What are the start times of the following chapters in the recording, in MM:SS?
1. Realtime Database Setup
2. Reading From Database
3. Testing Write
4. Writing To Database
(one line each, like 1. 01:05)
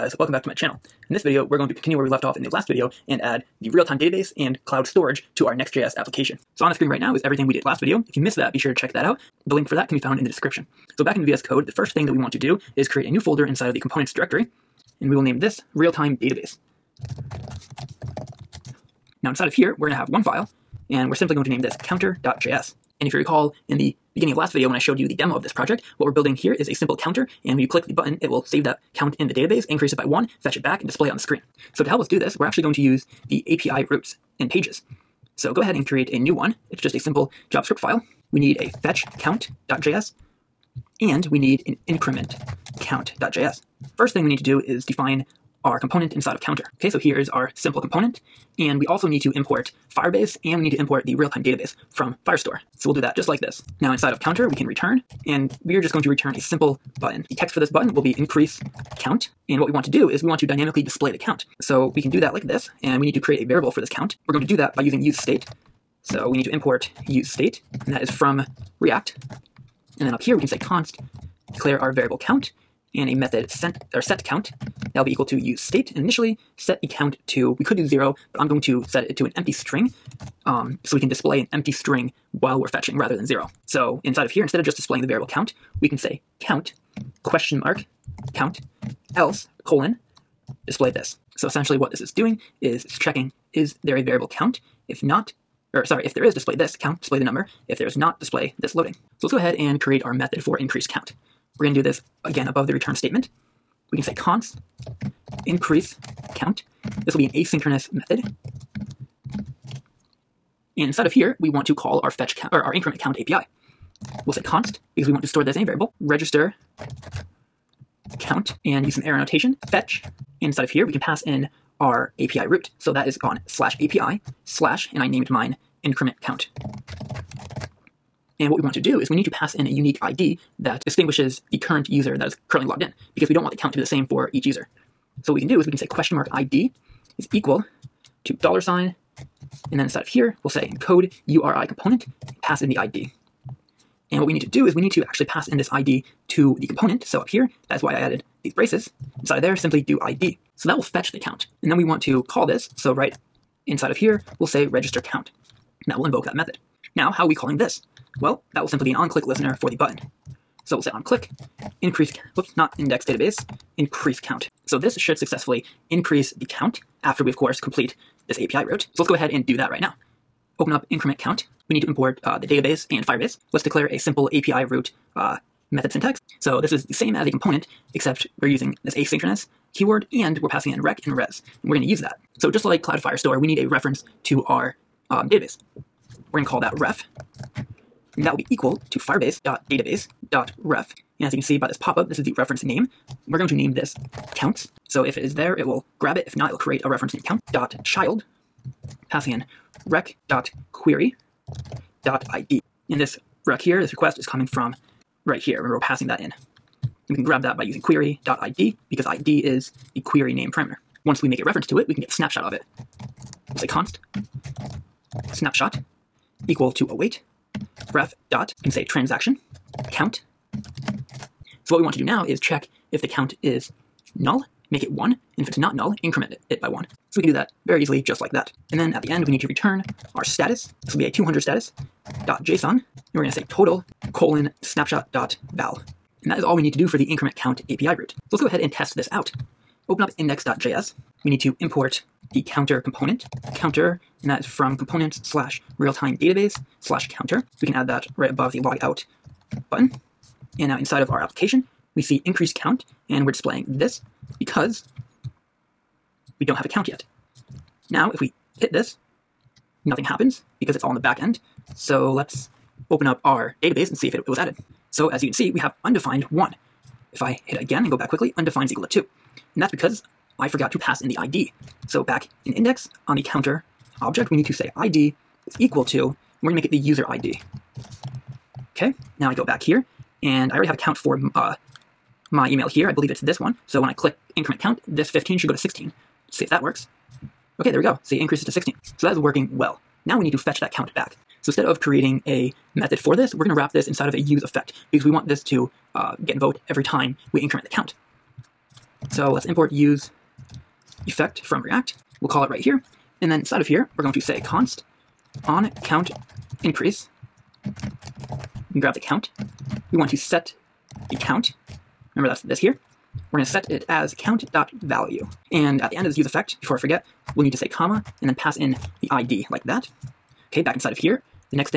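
1. 00:10
2. 04:49
3. 03:58
4. 01:38.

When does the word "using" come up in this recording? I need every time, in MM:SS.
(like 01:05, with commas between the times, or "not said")
01:04, 02:58, 03:27.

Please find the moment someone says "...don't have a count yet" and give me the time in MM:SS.
04:16.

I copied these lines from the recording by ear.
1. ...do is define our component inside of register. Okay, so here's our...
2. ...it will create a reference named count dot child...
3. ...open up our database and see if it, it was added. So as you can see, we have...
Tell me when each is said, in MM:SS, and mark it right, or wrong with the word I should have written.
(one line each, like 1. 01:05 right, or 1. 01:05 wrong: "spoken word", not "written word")
1. 00:44 wrong: "counter", not "register"
2. 03:16 right
3. 04:22 right.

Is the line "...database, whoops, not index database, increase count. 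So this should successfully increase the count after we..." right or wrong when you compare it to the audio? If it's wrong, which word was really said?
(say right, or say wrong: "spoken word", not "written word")
wrong: "increase", not "database".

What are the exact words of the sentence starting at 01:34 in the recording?
If not, or sorry, if there is, display this count, display the number.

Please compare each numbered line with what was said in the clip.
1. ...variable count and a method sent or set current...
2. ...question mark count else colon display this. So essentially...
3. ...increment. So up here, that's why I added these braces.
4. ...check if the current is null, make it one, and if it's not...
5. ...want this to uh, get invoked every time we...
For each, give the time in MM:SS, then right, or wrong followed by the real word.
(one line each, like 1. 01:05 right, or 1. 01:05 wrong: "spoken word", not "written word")
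1. 01:11 wrong: "count", not "current"
2. 01:27 right
3. 02:26 wrong: "component", not "increment"
4. 03:42 wrong: "count", not "current"
5. 04:55 right.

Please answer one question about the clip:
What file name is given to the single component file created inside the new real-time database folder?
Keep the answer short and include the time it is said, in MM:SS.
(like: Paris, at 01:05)
counter.js, at 00:21.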